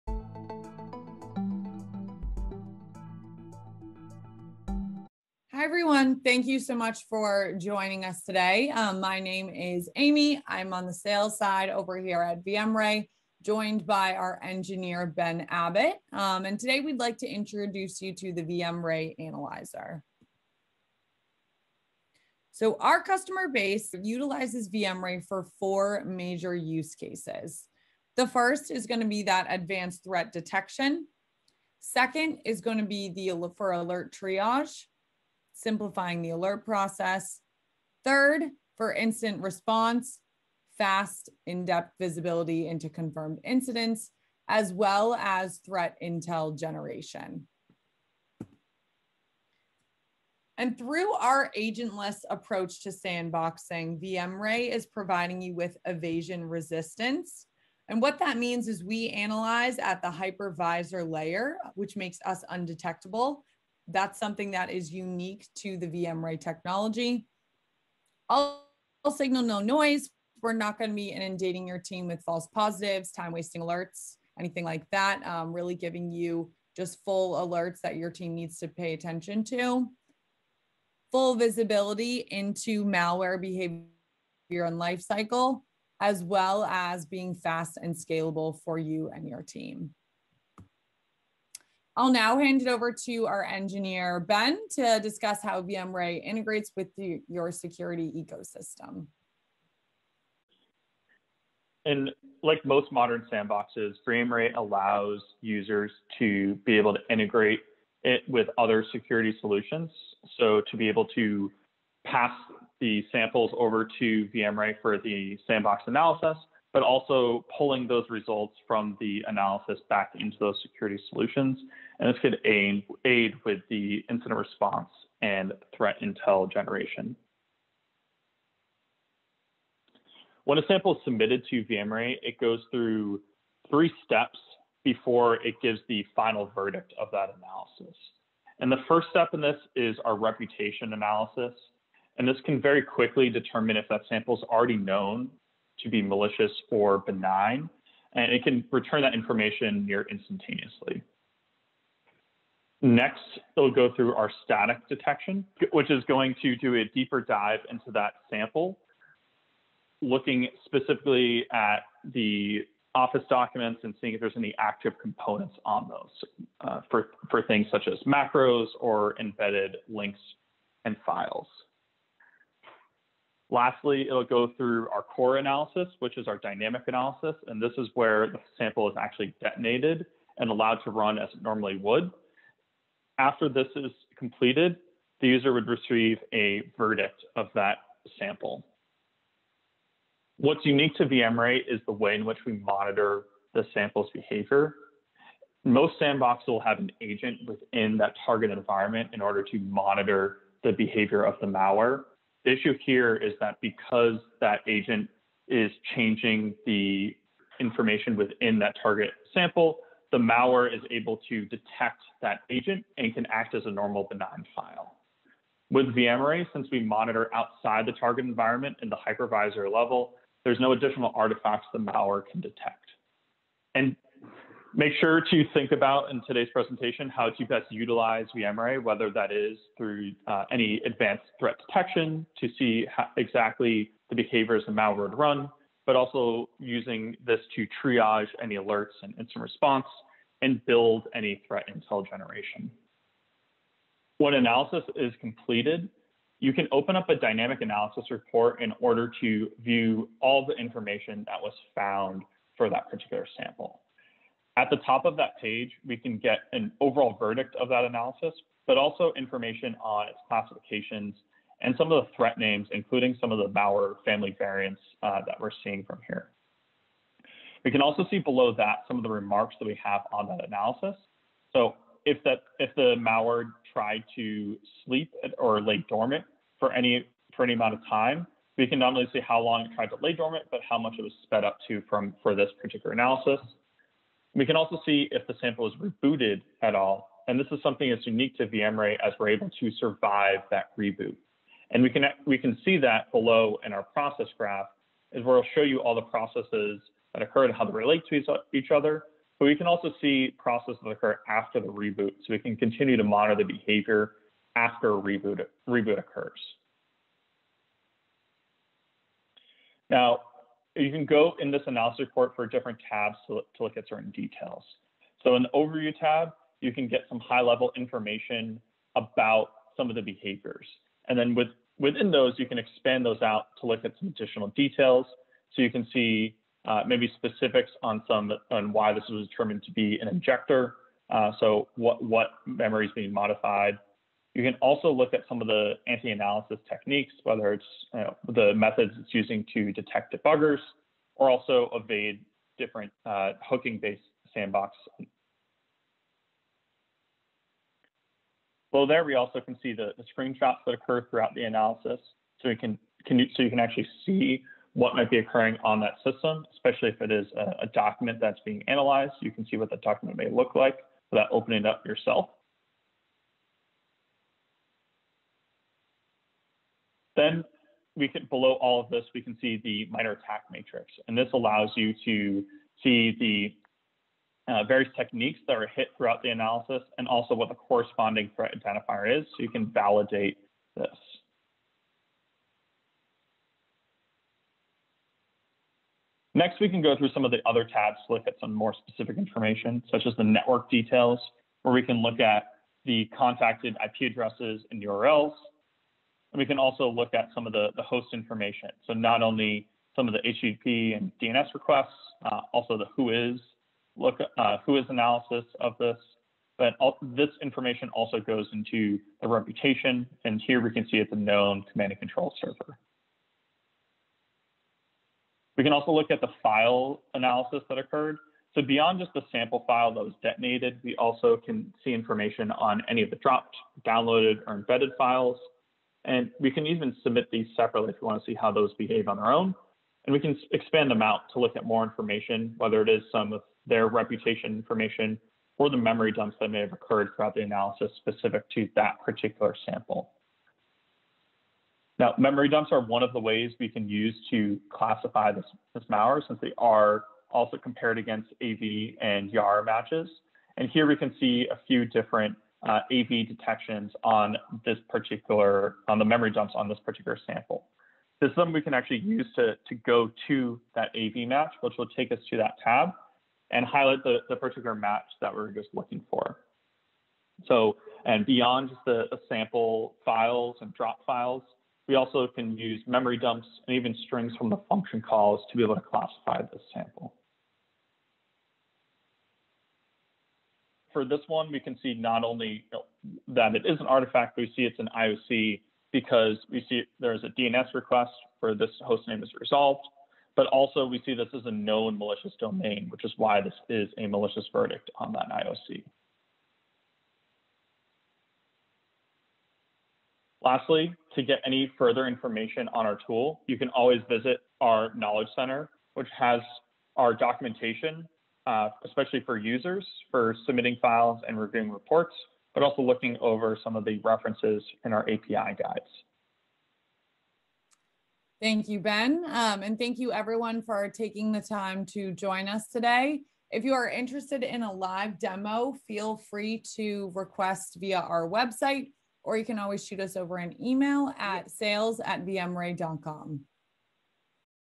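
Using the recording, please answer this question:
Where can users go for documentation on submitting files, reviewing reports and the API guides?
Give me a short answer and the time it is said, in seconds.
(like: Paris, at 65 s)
Knowledge Center, at 504 s.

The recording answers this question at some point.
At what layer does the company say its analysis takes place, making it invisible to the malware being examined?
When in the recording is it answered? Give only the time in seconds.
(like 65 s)
60 s.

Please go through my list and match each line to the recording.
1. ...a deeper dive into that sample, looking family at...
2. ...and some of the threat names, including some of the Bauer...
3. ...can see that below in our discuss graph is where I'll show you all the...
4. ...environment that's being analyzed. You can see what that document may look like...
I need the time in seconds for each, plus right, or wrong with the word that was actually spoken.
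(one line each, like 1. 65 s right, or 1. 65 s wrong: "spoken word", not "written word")
1. 156 s wrong: "specifically", not "family"
2. 261 s right
3. 292 s wrong: "process", not "discuss"
4. 357 s wrong: "document", not "environment".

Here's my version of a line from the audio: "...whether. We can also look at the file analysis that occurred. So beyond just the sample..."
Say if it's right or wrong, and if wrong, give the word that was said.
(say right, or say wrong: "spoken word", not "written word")
wrong: "server", not "whether".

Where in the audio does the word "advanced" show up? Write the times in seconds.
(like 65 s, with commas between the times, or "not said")
29 s, 230 s.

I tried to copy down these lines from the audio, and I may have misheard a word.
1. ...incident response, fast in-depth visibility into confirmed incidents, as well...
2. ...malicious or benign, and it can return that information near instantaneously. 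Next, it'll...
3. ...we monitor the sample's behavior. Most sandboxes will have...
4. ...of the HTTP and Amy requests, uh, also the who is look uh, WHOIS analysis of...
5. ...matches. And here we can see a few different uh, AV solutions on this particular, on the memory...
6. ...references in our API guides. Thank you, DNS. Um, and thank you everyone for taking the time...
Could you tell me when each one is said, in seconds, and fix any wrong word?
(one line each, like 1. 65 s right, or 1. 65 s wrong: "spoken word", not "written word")
1. 38 s right
2. 146 s right
3. 192 s right
4. 400 s wrong: "DNS", not "Amy"
5. 449 s wrong: "detections", not "solutions"
6. 514 s wrong: "Ben", not "DNS".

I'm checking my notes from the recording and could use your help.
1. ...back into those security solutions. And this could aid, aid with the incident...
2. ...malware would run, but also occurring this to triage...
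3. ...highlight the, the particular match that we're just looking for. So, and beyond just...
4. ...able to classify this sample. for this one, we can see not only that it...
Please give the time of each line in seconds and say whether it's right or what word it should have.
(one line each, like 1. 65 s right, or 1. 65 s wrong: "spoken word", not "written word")
1. 119 s right
2. 234 s wrong: "using", not "occurring"
3. 463 s right
4. 475 s right.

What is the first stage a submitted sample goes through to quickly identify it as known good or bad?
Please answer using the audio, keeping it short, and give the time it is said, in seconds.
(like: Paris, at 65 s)
reputation analysis, at 140 s.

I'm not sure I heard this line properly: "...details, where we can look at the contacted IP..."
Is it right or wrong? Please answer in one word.
right.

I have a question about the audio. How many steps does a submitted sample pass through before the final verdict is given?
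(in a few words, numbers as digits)
3.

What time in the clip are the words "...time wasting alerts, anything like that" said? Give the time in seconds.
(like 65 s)
73 s.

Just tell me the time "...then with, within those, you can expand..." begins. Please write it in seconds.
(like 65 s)
321 s.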